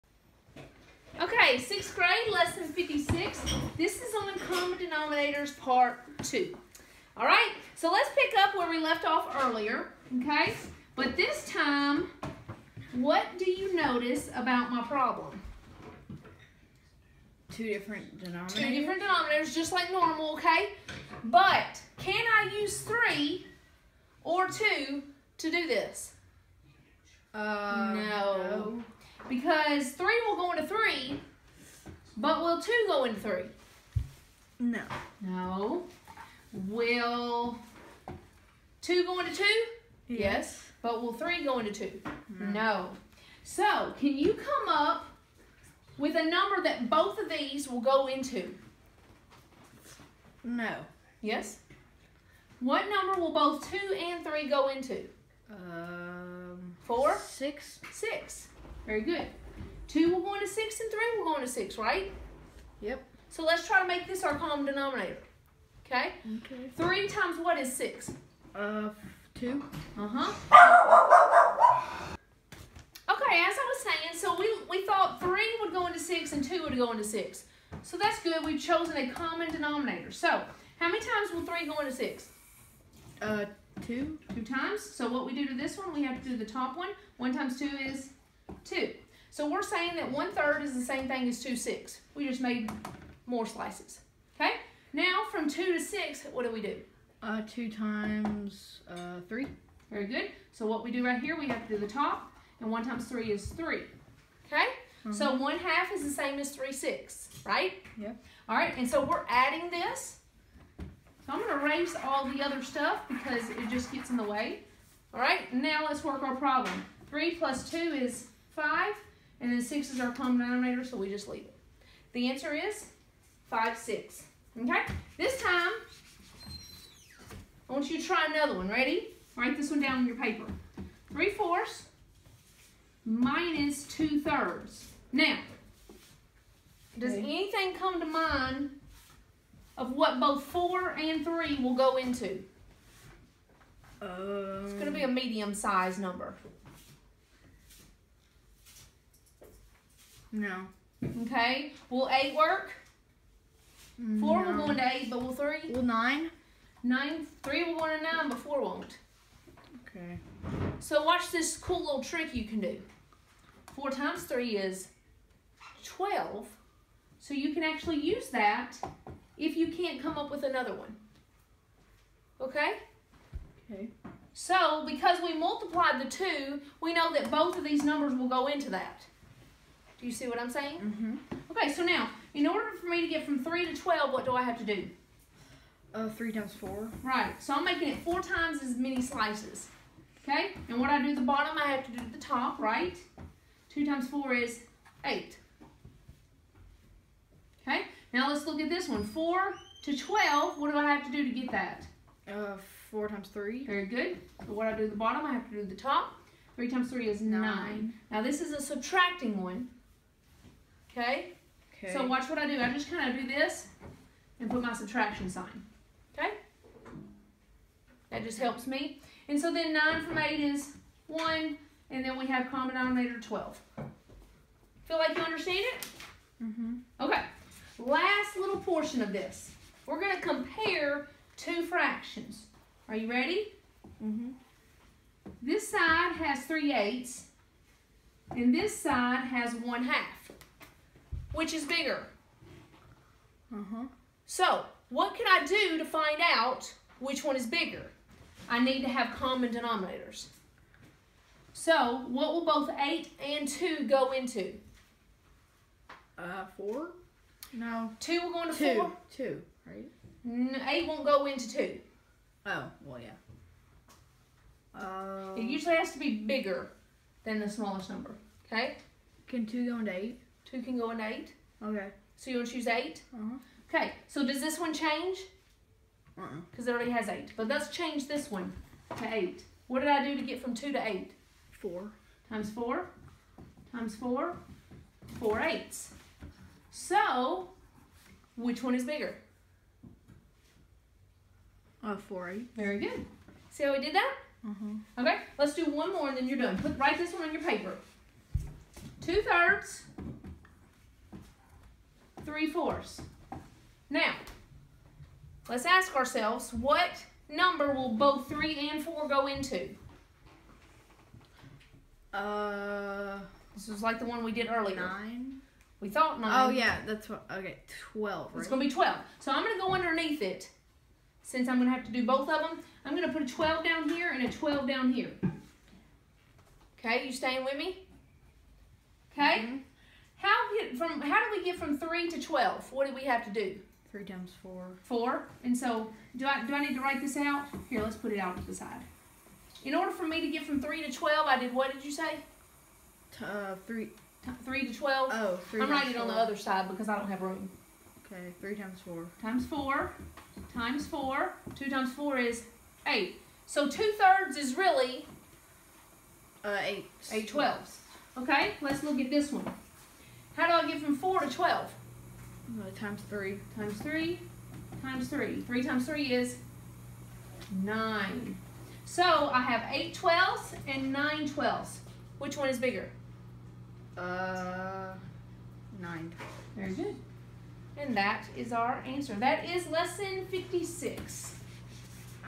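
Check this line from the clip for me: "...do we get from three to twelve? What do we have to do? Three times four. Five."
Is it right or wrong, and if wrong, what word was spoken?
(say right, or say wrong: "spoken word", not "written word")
wrong: "Four", not "Five".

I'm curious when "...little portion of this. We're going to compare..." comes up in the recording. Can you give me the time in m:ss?
3:48.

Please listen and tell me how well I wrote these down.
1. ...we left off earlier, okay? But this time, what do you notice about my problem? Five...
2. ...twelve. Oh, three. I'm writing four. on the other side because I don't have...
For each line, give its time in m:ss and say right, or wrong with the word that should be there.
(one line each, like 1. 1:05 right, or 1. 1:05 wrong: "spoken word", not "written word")
1. 0:08 wrong: "Two", not "Five"
2. 5:44 right.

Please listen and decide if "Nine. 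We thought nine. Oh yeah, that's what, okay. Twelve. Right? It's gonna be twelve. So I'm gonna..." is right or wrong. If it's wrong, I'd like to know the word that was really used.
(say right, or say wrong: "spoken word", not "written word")
right.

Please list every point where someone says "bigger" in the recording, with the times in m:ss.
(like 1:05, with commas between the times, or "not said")
4:01, 4:07, 4:26, 4:48, 6:12.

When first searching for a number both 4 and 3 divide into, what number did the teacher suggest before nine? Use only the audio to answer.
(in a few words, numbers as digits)
8.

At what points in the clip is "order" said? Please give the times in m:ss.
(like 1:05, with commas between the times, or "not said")
3:02, 5:39.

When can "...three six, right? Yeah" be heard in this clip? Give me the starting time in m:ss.
1:46.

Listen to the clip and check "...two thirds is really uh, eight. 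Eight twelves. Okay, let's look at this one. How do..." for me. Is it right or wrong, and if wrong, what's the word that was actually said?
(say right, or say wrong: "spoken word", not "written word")
right.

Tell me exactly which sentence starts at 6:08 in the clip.
So I have 8 twelfths and 9 twelfths.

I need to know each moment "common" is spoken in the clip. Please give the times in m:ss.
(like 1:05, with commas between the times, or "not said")
0:04, 1:04, 1:19, 2:00, 3:42, 4:09.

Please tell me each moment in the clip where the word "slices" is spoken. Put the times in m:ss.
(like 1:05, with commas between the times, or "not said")
1:33, 3:09.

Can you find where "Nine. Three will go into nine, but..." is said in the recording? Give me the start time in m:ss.
2:36.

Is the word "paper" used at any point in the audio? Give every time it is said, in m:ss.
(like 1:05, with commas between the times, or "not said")
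2:10, 4:57.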